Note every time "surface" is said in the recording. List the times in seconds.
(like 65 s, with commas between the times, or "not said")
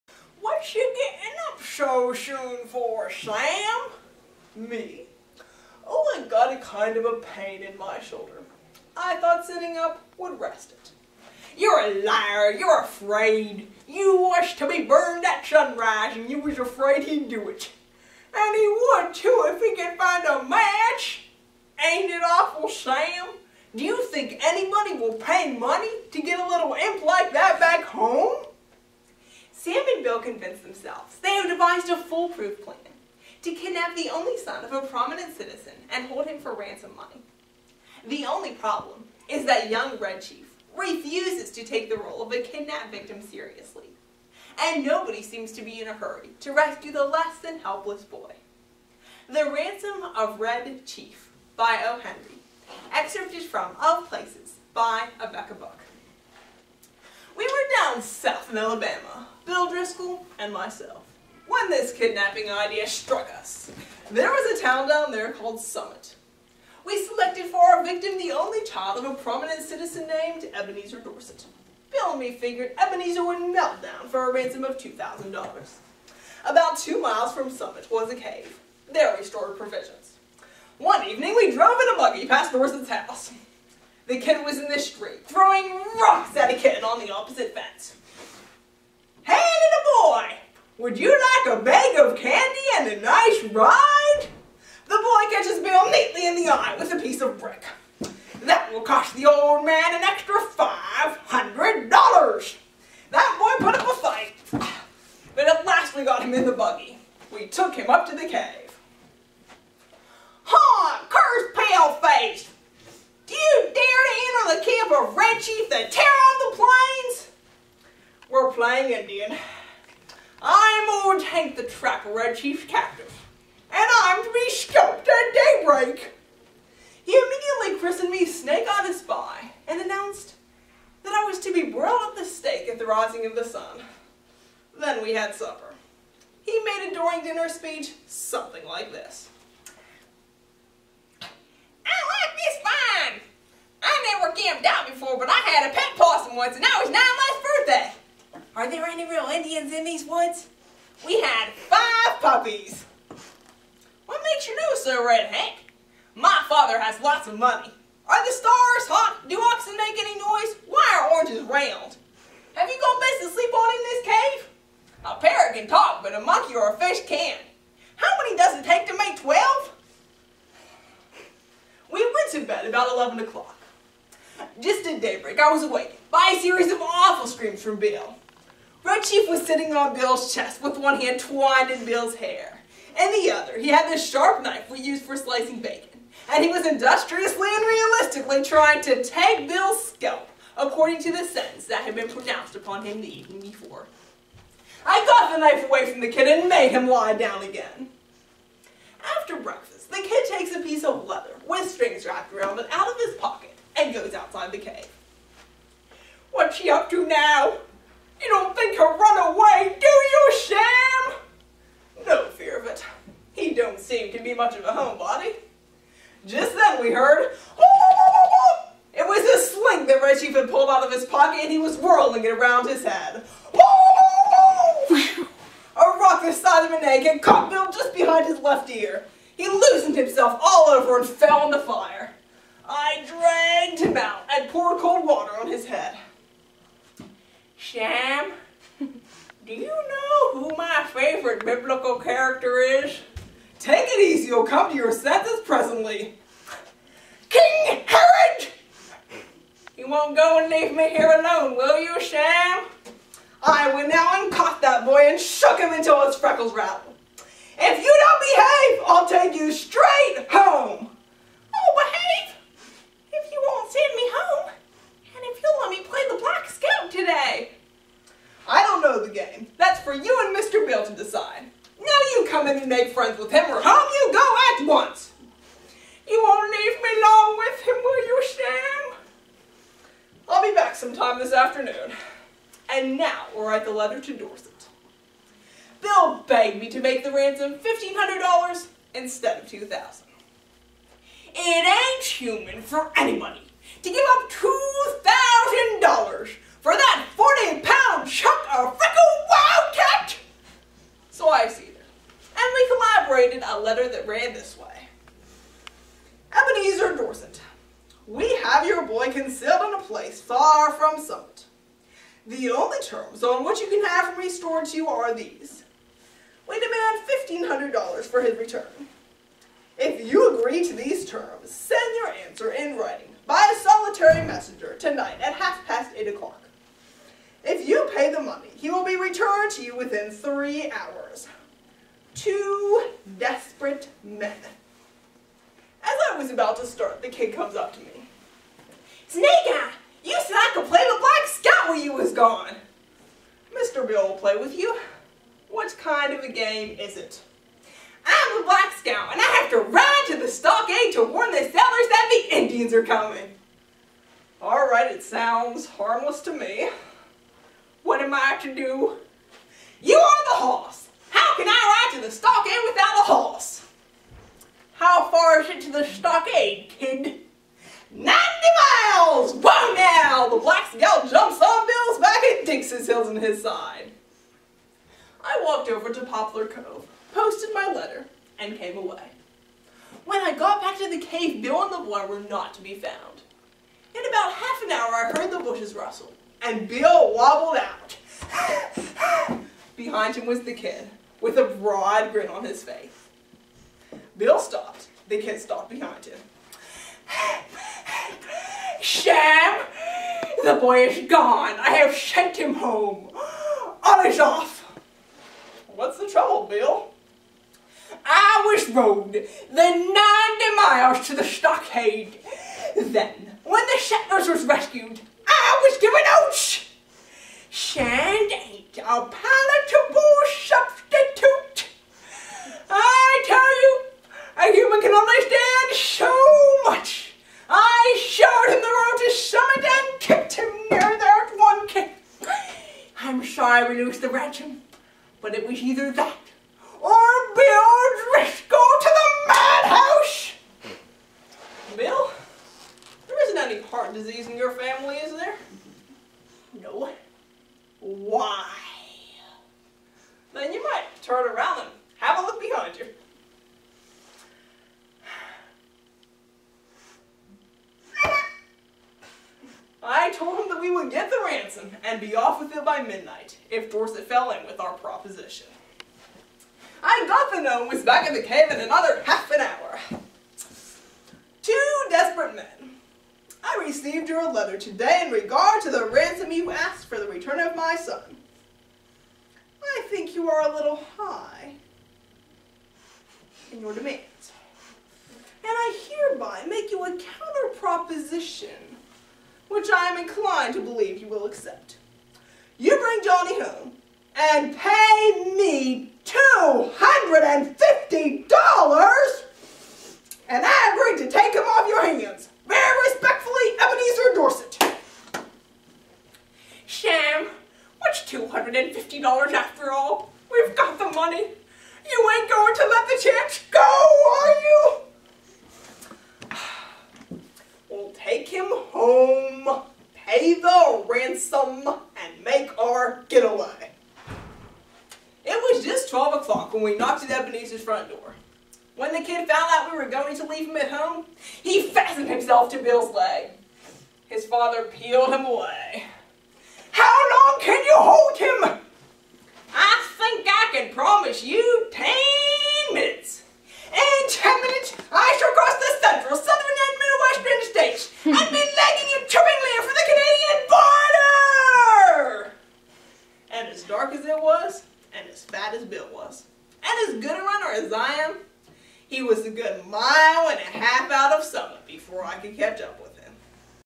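not said.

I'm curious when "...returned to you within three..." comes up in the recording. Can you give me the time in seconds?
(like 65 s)
328 s.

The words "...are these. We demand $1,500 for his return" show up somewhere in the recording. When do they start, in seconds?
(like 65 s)
314 s.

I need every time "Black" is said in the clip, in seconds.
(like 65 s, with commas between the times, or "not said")
266 s, 340 s, 348 s, 370 s.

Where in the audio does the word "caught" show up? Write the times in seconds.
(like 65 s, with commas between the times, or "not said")
227 s, 254 s.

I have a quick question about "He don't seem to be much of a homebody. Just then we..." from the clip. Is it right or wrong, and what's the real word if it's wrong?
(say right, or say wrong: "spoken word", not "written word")
right.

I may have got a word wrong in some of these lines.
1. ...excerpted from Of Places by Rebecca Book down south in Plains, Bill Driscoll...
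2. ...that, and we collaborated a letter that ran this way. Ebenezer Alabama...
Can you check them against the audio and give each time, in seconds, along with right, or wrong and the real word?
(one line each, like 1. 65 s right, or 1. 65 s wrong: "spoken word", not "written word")
1. 52 s wrong: "Alabama", not "Plains"
2. 301 s wrong: "Dorset", not "Alabama".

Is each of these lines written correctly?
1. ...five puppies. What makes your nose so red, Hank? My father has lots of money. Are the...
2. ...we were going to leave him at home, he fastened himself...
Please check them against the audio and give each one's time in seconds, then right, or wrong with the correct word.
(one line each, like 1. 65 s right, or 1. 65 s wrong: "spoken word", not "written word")
1. 151 s right
2. 529 s right.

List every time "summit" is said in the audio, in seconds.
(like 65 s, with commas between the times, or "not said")
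65 s, 77 s, 311 s, 429 s.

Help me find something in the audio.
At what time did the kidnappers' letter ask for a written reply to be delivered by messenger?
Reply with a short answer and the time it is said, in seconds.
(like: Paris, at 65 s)
half past 8, at 325 s.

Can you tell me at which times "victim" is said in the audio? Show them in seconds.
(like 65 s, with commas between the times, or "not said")
42 s, 67 s.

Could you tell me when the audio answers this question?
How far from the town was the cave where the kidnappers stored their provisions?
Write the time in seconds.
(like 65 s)
76 s.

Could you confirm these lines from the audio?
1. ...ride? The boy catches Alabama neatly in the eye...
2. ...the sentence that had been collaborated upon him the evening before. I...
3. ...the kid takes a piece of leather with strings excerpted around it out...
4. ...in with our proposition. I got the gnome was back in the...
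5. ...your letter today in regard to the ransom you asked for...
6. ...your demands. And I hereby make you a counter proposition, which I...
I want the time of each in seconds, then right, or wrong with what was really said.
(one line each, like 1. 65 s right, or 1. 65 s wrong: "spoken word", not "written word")
1. 93 s wrong: "Bill", not "Alabama"
2. 191 s wrong: "pronounced", not "collaborated"
3. 199 s wrong: "wrapped", not "excerpted"
4. 464 s right
5. 474 s right
6. 483 s right.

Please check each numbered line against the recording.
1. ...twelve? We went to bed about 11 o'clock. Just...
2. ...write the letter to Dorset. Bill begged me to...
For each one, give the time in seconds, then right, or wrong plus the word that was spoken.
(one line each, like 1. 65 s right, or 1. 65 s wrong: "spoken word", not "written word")
1. 169 s right
2. 283 s right.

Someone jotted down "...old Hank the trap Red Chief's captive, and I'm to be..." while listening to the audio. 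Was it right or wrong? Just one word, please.
right.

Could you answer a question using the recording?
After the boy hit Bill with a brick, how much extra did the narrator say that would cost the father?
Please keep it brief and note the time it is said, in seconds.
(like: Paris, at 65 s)
$500, at 100 s.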